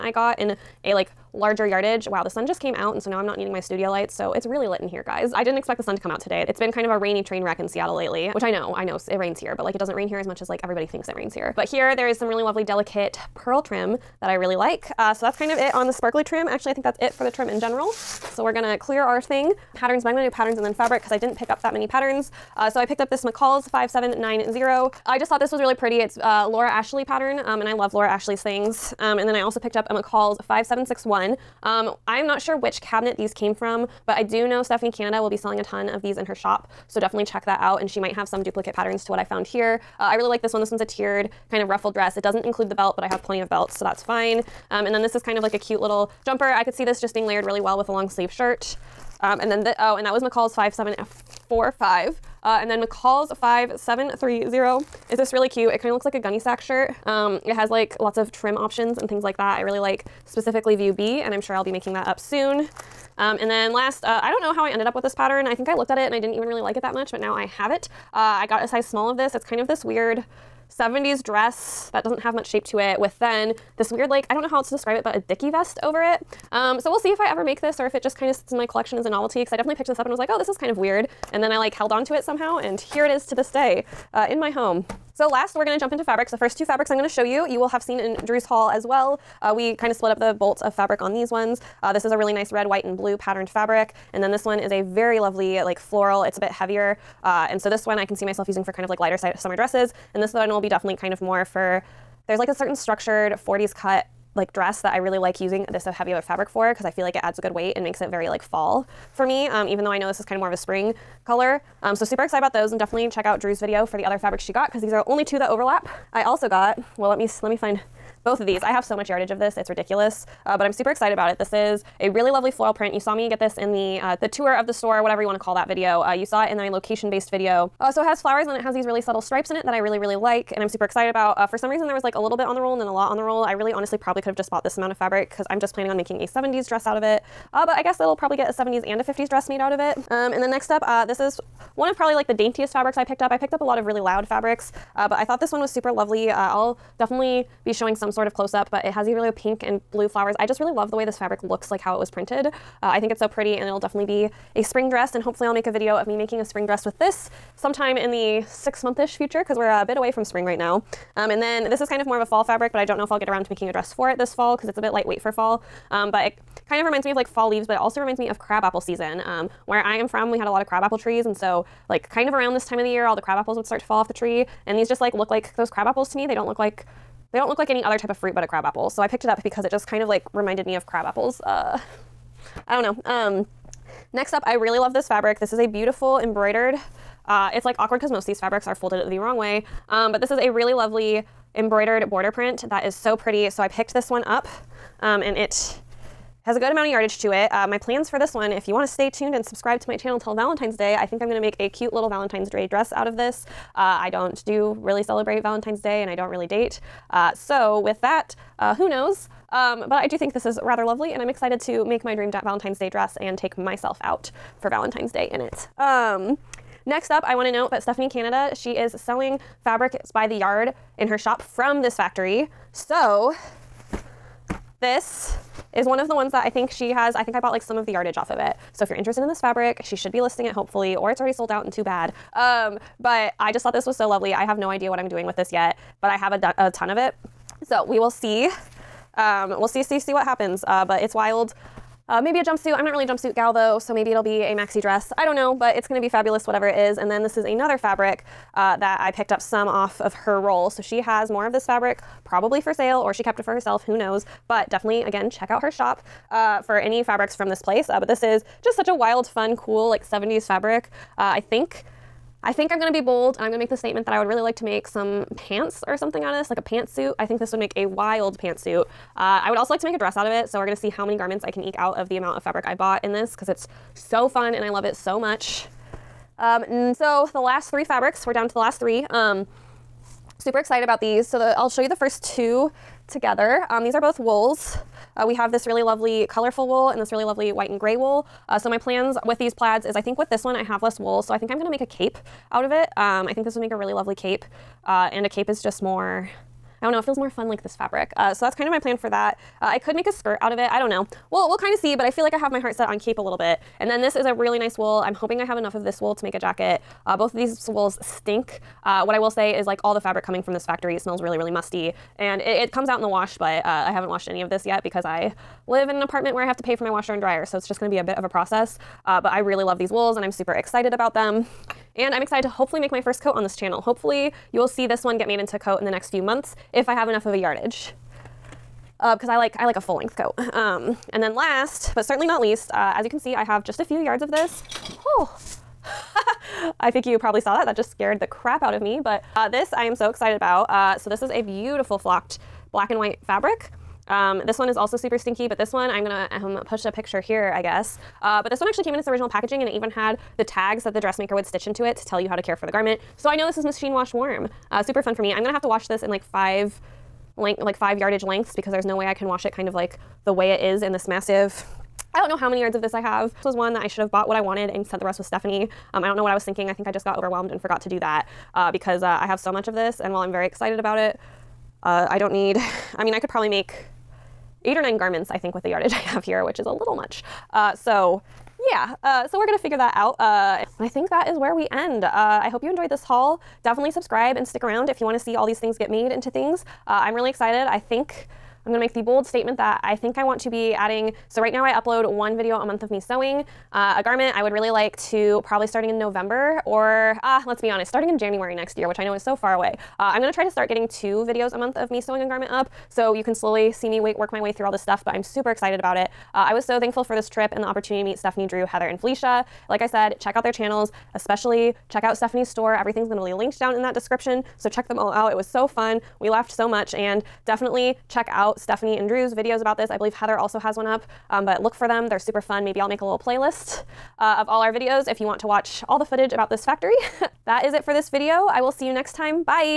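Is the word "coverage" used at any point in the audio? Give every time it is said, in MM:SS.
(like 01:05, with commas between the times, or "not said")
not said.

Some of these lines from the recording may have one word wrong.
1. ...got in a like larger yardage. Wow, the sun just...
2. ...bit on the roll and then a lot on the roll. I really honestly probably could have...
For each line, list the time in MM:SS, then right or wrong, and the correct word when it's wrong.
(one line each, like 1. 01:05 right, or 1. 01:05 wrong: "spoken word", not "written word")
1. 00:00 right
2. 02:12 right.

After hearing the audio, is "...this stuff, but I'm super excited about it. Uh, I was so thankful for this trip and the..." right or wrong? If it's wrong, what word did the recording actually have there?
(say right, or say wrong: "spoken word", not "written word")
right.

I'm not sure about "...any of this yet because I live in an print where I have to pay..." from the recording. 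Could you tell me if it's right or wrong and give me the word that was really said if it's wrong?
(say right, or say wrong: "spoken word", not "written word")
wrong: "apartment", not "print".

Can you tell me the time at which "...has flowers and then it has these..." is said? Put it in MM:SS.
02:08.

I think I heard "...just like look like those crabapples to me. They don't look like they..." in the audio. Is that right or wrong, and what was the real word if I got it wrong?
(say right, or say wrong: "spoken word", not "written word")
right.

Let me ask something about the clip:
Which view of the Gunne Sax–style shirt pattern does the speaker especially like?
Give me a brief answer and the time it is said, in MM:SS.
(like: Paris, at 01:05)
View B, at 01:00.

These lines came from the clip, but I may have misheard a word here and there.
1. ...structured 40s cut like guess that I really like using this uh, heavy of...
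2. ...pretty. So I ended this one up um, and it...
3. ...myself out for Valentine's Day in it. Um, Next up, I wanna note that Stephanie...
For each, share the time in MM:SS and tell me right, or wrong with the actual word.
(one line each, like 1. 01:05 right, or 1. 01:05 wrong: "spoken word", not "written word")
1. 01:42 wrong: "dress", not "guess"
2. 03:13 wrong: "picked", not "ended"
3. 03:33 right.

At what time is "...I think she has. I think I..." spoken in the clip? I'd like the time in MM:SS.
03:46.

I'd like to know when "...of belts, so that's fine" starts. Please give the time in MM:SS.
00:43.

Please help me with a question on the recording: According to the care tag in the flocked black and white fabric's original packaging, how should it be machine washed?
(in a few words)
Warm.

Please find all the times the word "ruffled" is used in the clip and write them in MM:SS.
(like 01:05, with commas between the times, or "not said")
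00:41.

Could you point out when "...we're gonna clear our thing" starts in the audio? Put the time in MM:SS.
00:18.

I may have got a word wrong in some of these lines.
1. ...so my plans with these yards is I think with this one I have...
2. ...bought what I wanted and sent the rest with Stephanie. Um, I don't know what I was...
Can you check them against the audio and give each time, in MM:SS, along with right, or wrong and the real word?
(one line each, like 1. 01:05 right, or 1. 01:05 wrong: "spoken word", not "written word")
1. 04:48 wrong: "plaids", not "yards"
2. 06:04 right.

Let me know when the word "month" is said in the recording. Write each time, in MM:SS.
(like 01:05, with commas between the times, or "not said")
02:38, 05:26, 06:32, 06:41.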